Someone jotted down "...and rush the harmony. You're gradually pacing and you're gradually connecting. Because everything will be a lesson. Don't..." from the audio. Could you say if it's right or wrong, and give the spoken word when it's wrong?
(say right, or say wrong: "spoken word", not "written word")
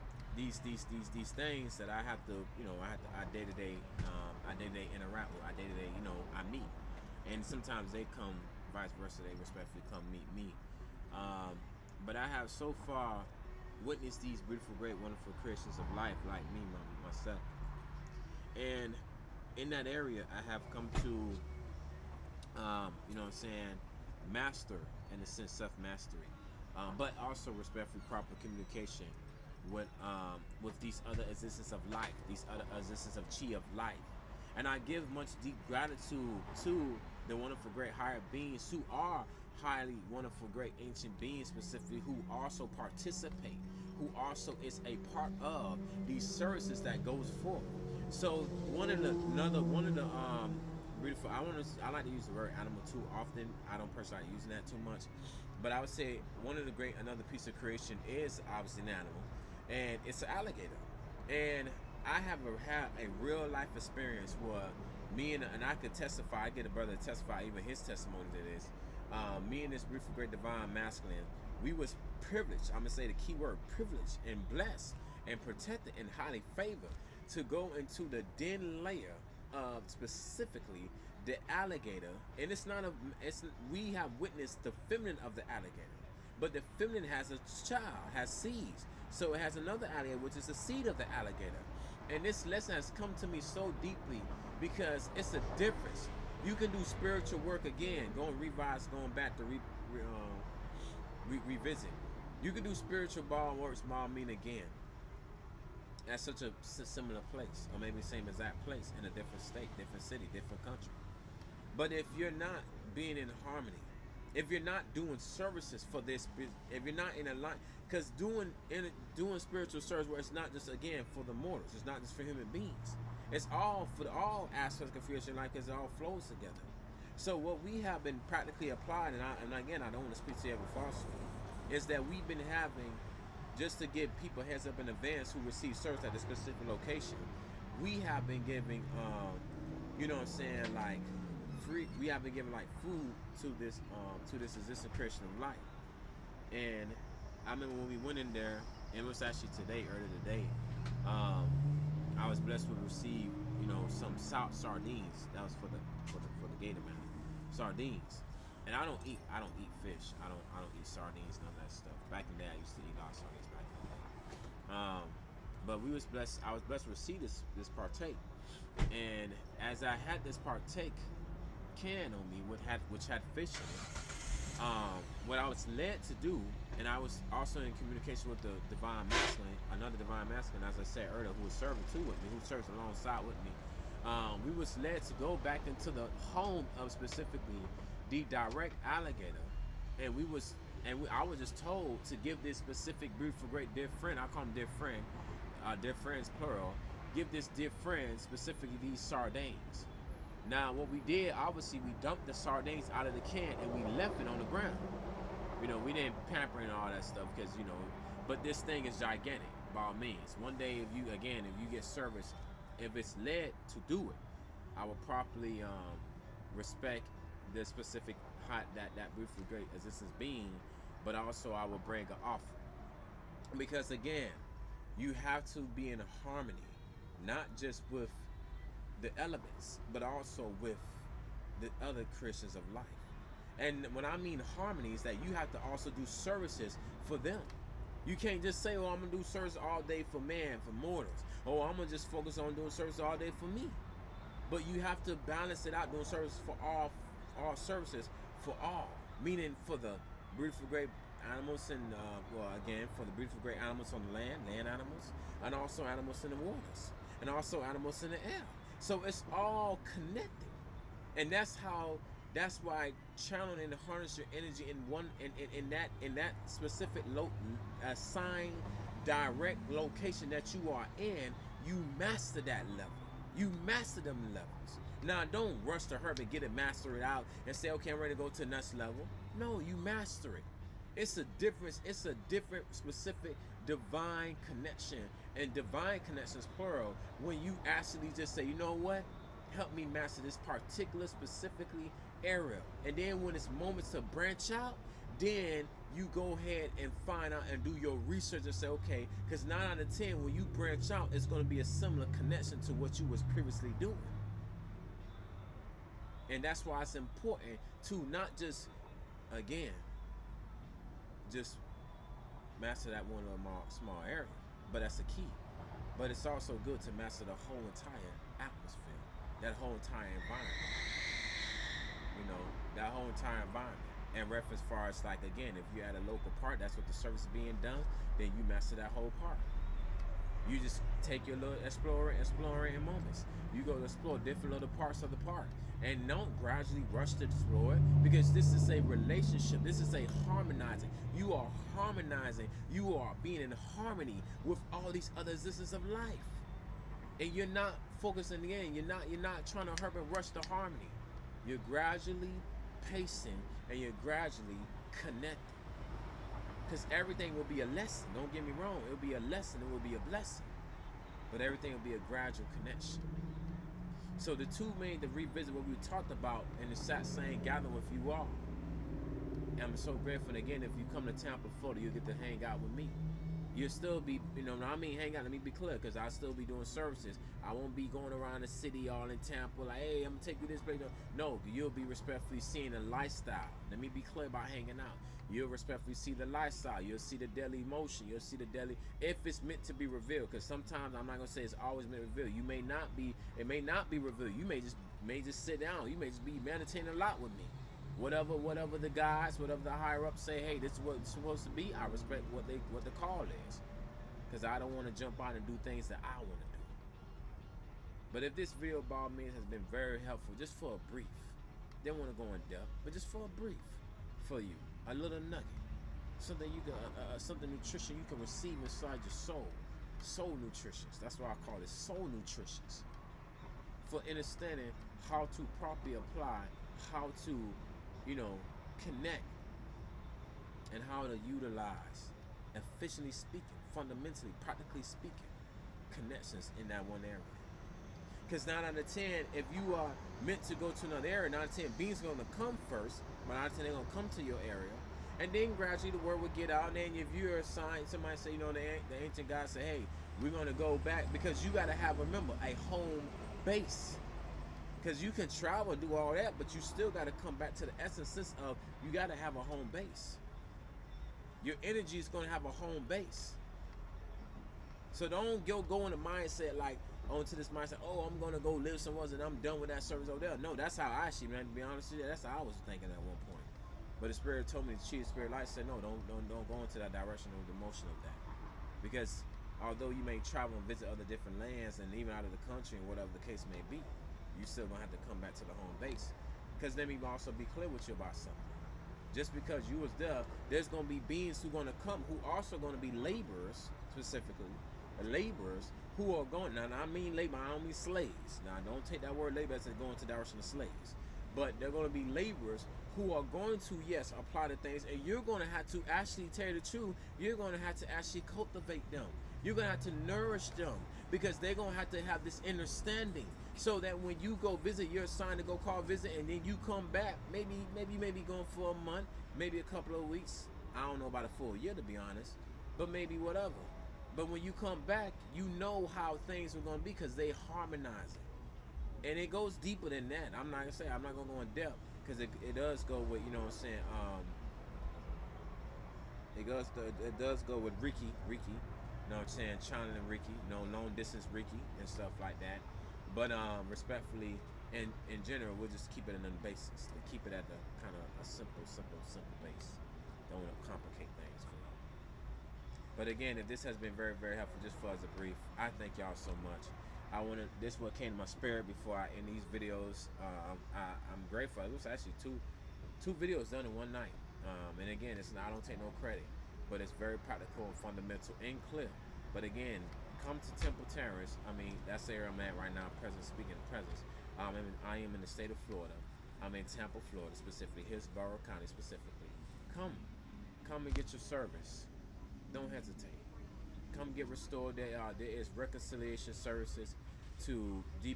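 right.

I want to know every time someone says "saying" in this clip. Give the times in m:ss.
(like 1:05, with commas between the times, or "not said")
0:23, 2:20, 8:53, 8:59.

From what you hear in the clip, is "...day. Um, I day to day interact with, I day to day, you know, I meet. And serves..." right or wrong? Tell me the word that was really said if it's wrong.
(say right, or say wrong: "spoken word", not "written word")
wrong: "sometimes", not "serves".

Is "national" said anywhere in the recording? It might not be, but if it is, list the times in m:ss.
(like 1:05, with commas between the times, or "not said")
not said.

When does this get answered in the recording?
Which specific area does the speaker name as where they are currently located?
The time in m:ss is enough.
9:30.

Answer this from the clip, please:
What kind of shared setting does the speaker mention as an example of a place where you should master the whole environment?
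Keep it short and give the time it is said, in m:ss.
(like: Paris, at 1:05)
Local park, at 5:26.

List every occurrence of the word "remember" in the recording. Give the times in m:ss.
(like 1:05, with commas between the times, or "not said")
2:27, 7:31.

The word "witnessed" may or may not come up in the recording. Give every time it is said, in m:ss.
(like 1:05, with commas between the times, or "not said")
0:13, 1:24.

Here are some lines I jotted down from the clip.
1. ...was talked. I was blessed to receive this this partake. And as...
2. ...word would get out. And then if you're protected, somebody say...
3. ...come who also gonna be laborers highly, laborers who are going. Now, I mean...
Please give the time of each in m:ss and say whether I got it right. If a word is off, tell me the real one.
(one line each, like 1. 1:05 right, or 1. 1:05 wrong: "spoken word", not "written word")
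1. 2:45 wrong: "blessed", not "talked"
2. 7:25 wrong: "assigned", not "protected"
3. 8:11 wrong: "specifically", not "highly".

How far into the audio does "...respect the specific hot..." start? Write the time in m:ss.
3:36.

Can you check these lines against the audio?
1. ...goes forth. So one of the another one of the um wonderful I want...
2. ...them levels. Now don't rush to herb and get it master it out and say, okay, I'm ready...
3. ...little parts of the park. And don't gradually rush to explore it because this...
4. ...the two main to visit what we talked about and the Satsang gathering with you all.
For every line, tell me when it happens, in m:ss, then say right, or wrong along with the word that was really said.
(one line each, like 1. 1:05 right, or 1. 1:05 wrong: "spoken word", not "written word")
1. 0:47 wrong: "beautiful", not "wonderful"
2. 4:34 right
3. 5:34 right
4. 6:04 wrong: "revisit", not "visit".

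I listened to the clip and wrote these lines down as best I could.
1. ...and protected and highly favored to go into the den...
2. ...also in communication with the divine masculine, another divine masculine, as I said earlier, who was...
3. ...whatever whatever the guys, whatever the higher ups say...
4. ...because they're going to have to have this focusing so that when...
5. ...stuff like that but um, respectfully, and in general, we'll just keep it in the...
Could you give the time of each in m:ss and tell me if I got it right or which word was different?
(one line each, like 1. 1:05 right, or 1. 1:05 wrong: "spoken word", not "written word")
1. 1:15 right
2. 2:57 right
3. 6:37 right
4. 8:31 wrong: "understanding", not "focusing"
5. 9:01 right.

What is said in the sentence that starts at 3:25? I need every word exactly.
You know, we didn't pamper and all that stuff because, you know, but this thing is gigantic by all means.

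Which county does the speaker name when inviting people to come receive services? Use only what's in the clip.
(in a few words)
Hillsborough County.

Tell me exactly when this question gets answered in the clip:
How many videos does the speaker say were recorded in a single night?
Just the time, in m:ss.
9:22.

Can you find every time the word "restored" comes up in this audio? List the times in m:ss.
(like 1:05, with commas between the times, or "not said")
9:44.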